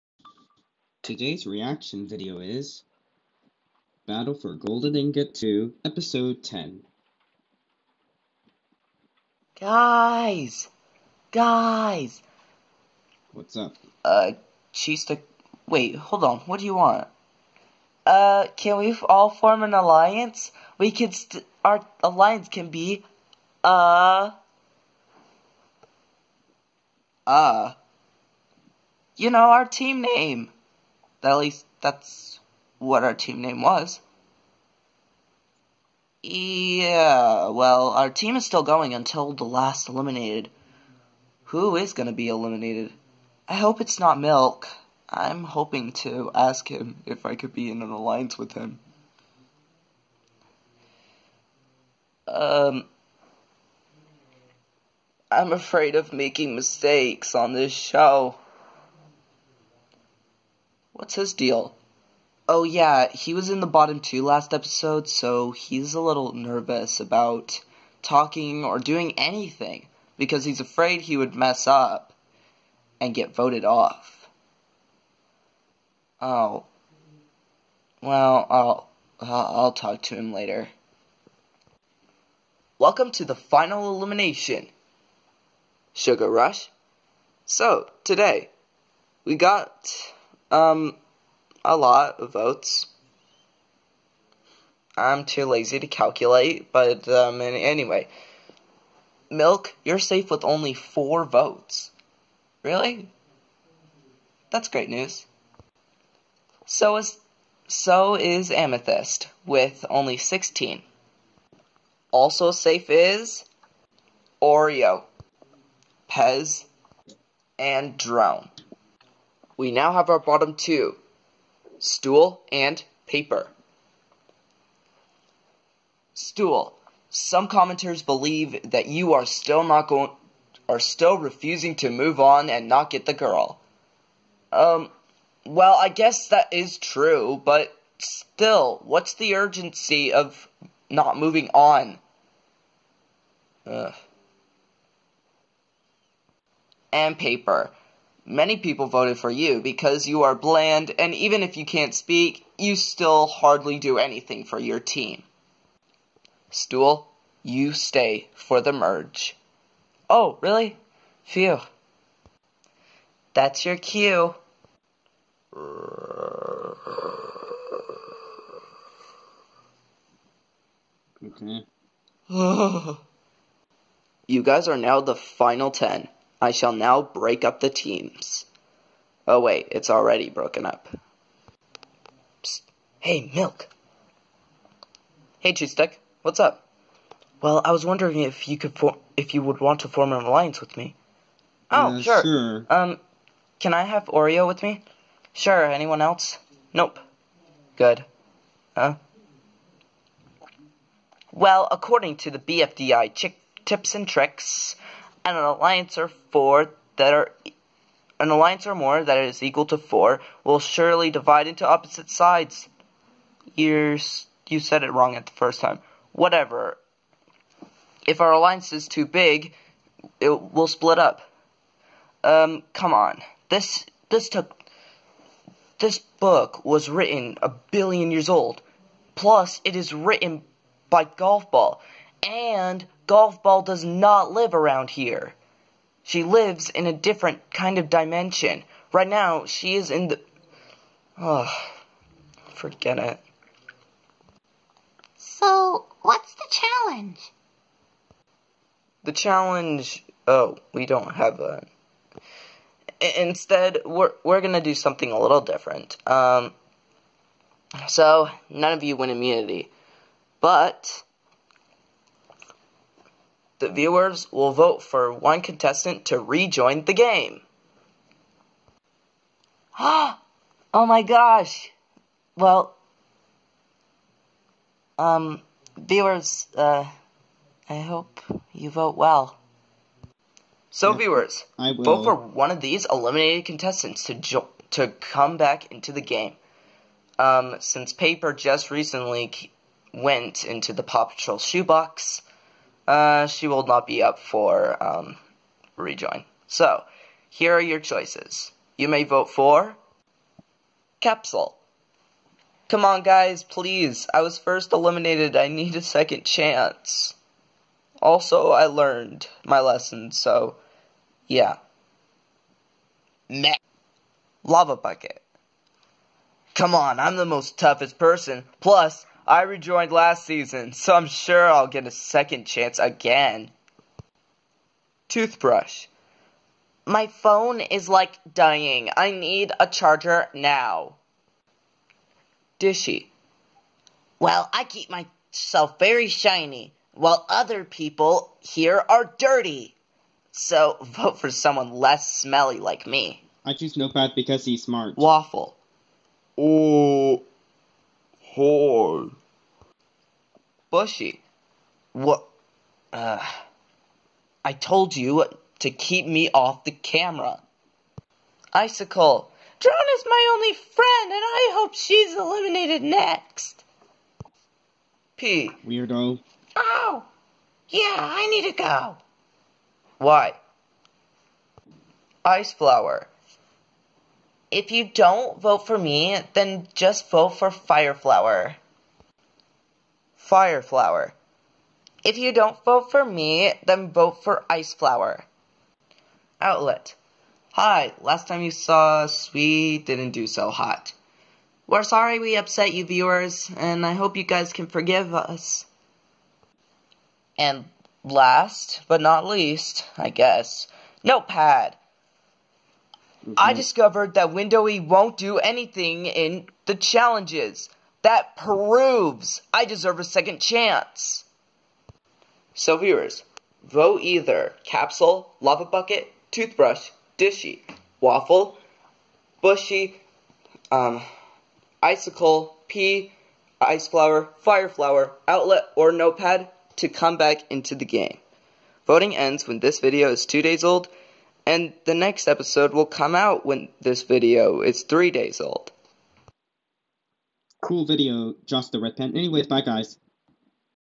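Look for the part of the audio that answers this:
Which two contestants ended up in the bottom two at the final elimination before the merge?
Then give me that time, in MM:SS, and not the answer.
02:01.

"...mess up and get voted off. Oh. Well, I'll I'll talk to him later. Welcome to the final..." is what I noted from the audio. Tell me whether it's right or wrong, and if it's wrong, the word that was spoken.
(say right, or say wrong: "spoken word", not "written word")
right.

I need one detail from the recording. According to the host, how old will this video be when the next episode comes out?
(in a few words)
three days old.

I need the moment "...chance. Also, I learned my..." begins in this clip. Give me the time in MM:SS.
05:06.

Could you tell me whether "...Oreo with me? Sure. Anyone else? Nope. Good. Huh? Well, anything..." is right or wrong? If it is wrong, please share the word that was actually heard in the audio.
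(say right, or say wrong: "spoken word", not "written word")
wrong: "according", not "anything".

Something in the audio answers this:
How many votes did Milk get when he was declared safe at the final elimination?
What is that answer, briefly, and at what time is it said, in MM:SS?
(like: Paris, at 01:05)
4, at 01:40.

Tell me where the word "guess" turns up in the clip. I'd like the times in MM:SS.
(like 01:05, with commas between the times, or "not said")
02:15, 06:40.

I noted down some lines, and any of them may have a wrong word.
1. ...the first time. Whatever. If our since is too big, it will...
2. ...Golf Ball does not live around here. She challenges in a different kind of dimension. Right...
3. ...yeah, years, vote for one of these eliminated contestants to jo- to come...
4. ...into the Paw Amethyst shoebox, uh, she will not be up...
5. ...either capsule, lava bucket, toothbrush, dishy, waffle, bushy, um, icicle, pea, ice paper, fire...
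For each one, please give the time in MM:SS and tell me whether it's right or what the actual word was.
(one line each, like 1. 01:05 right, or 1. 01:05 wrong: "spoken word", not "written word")
1. 03:35 wrong: "alliance", not "since"
2. 03:53 wrong: "lives", not "challenges"
3. 04:40 wrong: "viewers", not "years"
4. 04:50 wrong: "Patrol", not "Amethyst"
5. 06:54 wrong: "flower", not "paper".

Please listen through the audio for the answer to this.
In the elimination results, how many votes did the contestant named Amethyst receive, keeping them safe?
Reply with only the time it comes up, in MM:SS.
01:50.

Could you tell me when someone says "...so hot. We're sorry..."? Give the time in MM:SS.
06:30.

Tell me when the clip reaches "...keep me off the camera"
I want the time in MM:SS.
05:55.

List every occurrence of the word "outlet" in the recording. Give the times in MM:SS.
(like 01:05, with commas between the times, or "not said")
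06:26, 07:05.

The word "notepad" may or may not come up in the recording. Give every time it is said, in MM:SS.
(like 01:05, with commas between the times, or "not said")
05:43, 06:41, 07:05.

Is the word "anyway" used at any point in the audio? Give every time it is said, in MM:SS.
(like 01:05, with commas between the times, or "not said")
01:37, 07:19.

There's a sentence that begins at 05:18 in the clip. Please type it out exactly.
Plus, I rejoined last season, so I'm sure I'll get a second chance again.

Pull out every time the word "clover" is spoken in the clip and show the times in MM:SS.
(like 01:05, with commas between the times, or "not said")
not said.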